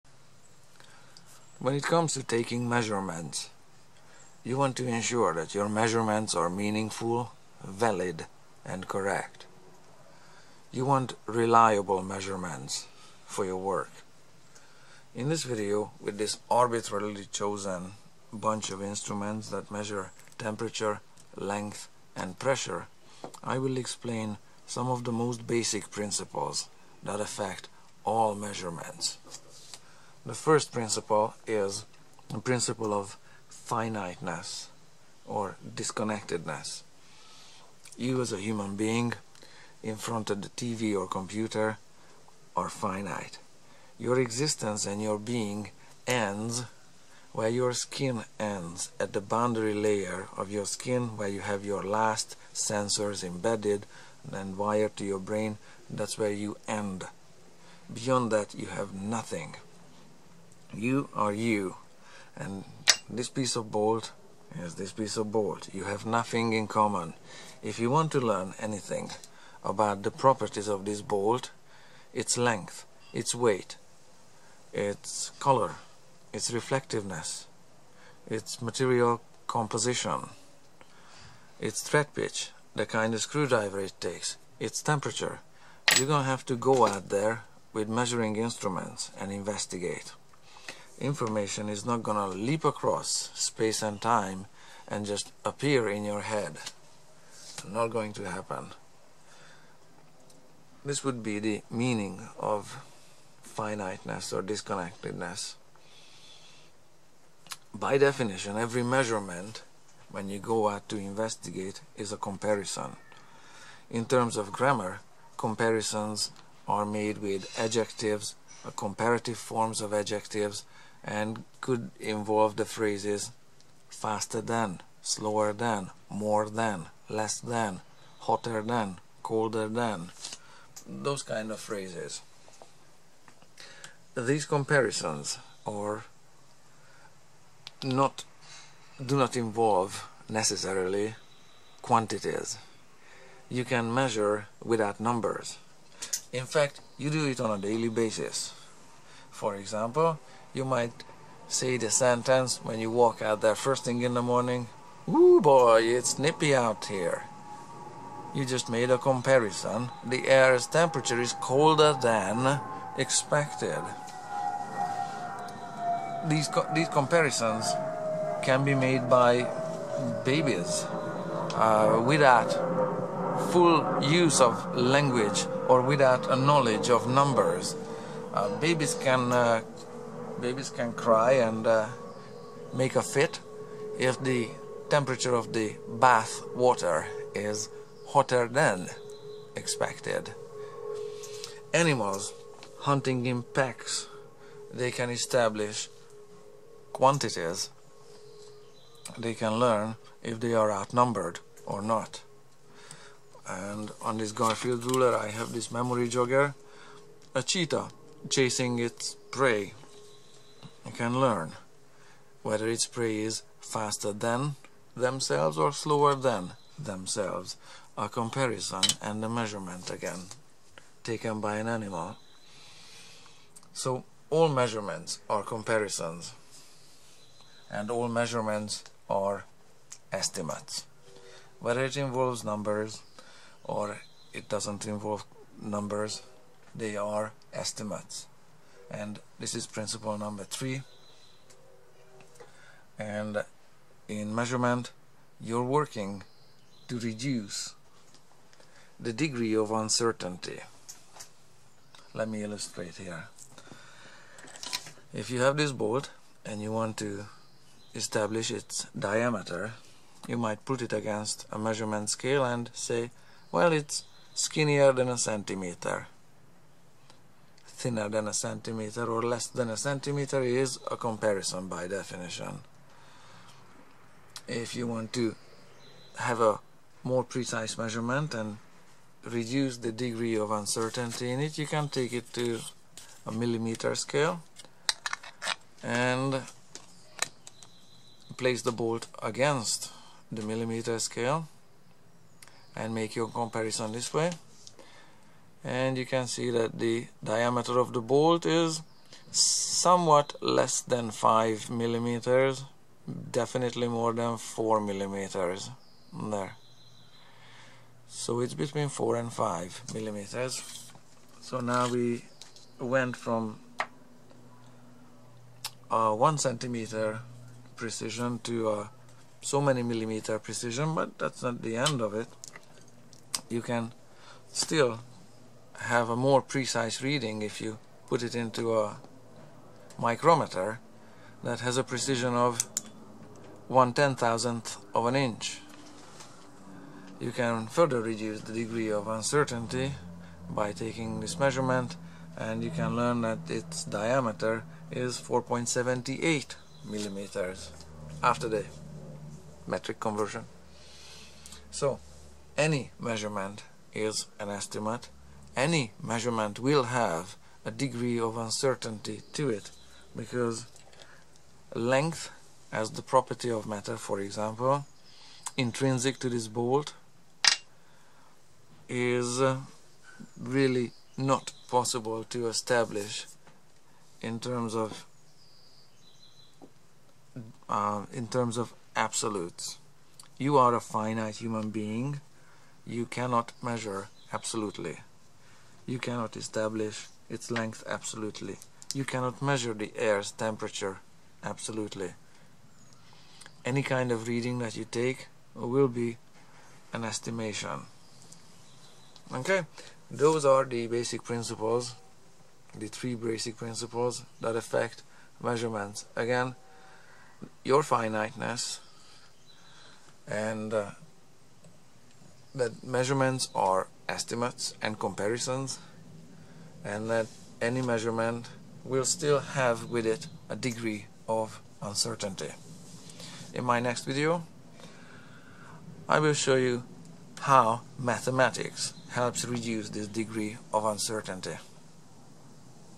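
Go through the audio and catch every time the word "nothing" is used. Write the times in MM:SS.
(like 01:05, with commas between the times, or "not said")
00:58, 01:06.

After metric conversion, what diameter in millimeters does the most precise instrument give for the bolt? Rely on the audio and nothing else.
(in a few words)
4.78 millimeters.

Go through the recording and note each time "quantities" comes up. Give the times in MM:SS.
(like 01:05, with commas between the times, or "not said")
02:21, 03:16.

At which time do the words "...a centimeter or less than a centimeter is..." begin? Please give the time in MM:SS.
04:28.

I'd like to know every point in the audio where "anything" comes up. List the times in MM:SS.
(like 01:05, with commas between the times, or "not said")
01:08.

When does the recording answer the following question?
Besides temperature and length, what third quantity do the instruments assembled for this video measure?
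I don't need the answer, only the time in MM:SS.
00:22.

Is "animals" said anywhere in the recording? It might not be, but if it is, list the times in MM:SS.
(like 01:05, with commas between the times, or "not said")
03:11, 03:41.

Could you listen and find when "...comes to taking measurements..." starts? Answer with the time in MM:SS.
00:01.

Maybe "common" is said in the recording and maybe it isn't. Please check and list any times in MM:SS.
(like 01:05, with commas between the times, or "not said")
01:06.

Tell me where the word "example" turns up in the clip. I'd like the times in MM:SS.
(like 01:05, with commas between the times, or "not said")
02:29, 06:04.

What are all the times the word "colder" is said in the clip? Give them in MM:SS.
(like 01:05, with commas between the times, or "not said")
02:09, 02:41.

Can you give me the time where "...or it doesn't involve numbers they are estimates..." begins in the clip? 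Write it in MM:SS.
03:53.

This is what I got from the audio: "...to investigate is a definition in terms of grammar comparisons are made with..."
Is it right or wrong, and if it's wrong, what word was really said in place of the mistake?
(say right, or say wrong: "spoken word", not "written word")
wrong: "comparison", not "definition".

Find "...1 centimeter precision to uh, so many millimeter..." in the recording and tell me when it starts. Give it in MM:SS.
05:16.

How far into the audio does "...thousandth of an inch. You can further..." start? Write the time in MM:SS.
05:34.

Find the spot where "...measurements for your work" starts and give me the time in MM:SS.
00:12.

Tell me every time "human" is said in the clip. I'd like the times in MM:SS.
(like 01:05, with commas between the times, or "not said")
00:38, 06:21.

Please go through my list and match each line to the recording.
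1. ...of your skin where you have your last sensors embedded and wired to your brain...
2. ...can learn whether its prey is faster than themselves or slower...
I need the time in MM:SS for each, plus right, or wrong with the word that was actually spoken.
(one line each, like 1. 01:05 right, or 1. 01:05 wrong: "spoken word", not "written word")
1. 00:50 right
2. 03:30 right.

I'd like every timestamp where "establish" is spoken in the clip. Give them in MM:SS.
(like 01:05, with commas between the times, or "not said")
03:15, 04:17, 06:12, 06:26.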